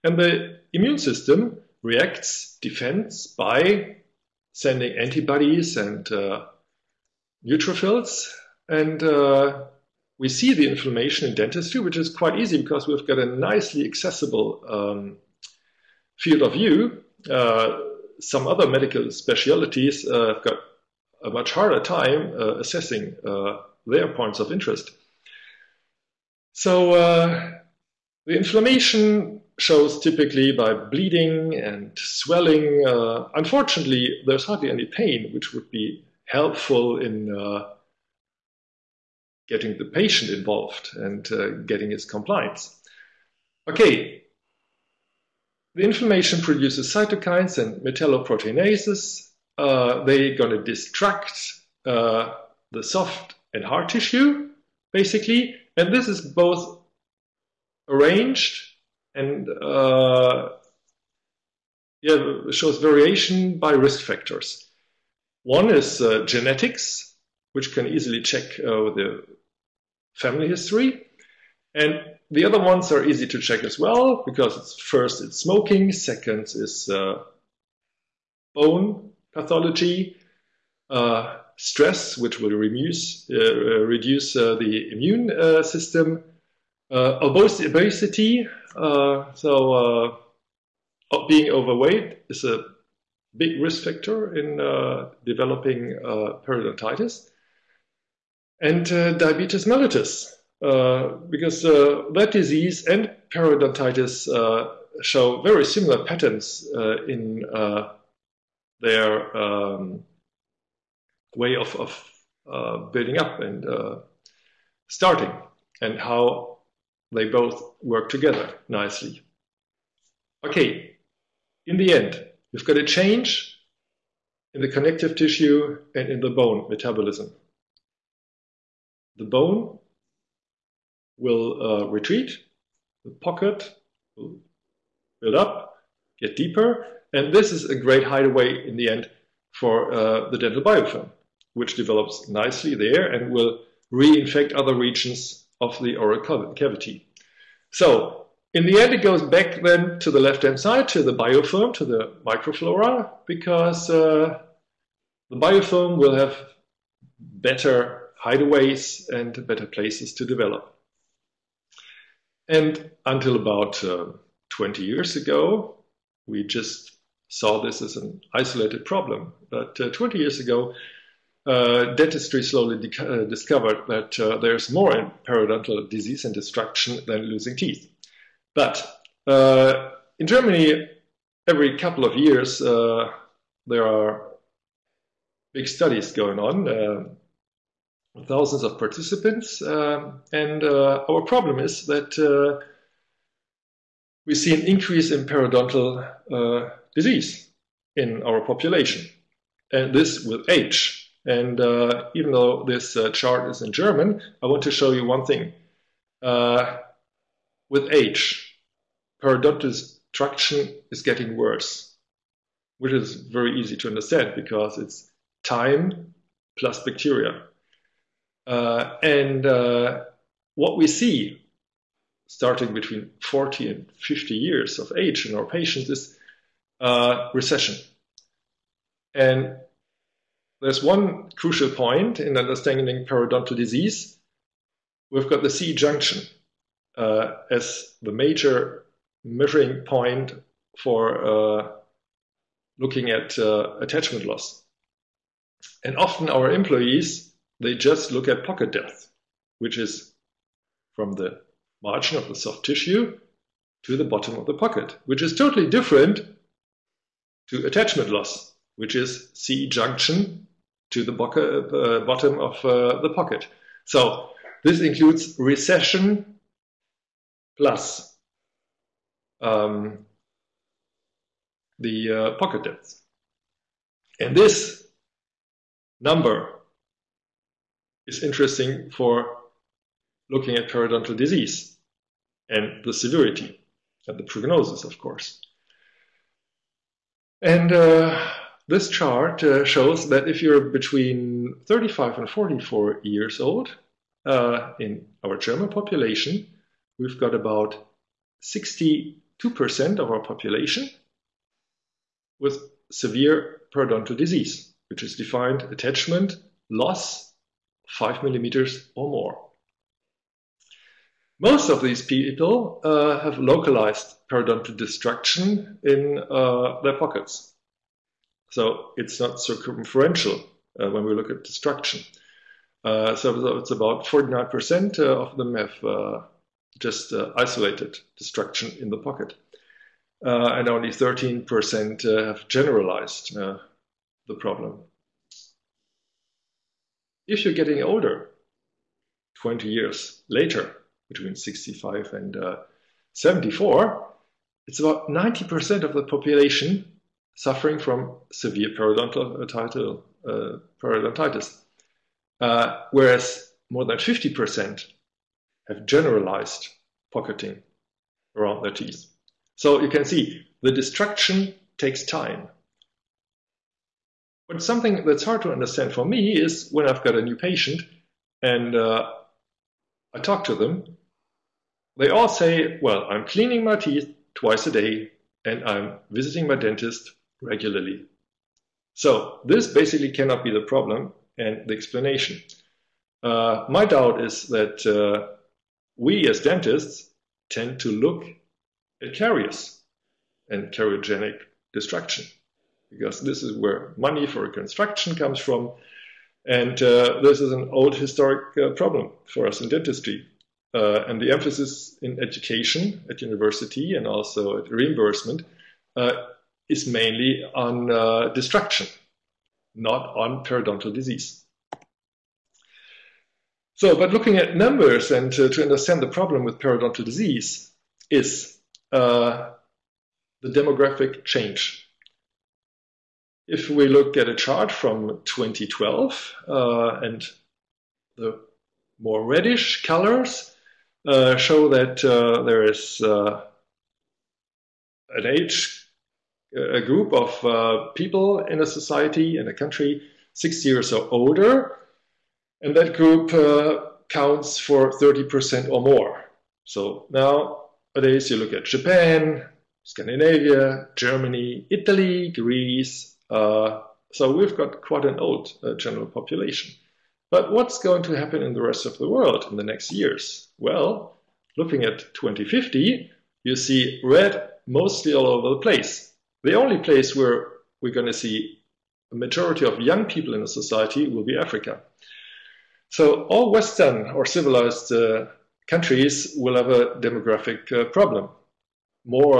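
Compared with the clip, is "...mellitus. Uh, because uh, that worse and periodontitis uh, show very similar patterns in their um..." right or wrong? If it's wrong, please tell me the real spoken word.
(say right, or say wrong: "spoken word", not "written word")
wrong: "disease", not "worse".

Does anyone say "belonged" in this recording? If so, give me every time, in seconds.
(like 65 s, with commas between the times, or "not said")
not said.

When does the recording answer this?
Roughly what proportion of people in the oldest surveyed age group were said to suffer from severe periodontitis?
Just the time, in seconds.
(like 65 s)
345 s.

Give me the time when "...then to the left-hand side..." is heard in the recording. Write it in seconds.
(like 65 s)
149 s.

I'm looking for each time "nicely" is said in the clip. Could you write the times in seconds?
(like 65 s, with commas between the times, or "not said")
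13 s, 118 s, 142 s.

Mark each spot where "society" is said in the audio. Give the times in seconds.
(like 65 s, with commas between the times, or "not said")
438 s, 470 s.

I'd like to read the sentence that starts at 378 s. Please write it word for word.
So, this basically cannot be the problem and the explanation.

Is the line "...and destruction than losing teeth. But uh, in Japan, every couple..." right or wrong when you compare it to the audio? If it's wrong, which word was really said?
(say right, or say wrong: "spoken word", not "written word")
wrong: "Germany", not "Japan".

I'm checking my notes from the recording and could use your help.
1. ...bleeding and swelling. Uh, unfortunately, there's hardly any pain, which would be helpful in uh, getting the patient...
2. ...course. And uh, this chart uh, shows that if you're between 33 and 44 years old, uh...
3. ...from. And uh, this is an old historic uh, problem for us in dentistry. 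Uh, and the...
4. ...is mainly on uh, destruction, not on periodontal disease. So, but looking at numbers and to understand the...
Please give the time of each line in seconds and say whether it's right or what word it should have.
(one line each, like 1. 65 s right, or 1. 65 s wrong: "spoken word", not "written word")
1. 30 s right
2. 284 s wrong: "35", not "33"
3. 395 s right
4. 406 s right.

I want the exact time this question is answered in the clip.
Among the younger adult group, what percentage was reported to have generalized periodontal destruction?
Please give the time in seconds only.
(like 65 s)
330 s.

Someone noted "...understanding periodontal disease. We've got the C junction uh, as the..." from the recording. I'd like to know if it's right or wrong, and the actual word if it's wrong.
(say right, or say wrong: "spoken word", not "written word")
right.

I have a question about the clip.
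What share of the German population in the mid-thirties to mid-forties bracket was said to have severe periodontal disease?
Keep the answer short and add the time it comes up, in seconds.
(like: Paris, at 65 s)
62%, at 298 s.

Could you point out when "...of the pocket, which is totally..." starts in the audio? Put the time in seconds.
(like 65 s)
254 s.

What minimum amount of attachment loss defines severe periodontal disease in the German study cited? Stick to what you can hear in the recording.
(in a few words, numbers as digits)
5 millimeters.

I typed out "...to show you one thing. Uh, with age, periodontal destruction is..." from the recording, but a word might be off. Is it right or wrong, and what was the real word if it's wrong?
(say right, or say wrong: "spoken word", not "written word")
right.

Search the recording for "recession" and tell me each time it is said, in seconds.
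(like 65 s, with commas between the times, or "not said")
227 s, 265 s.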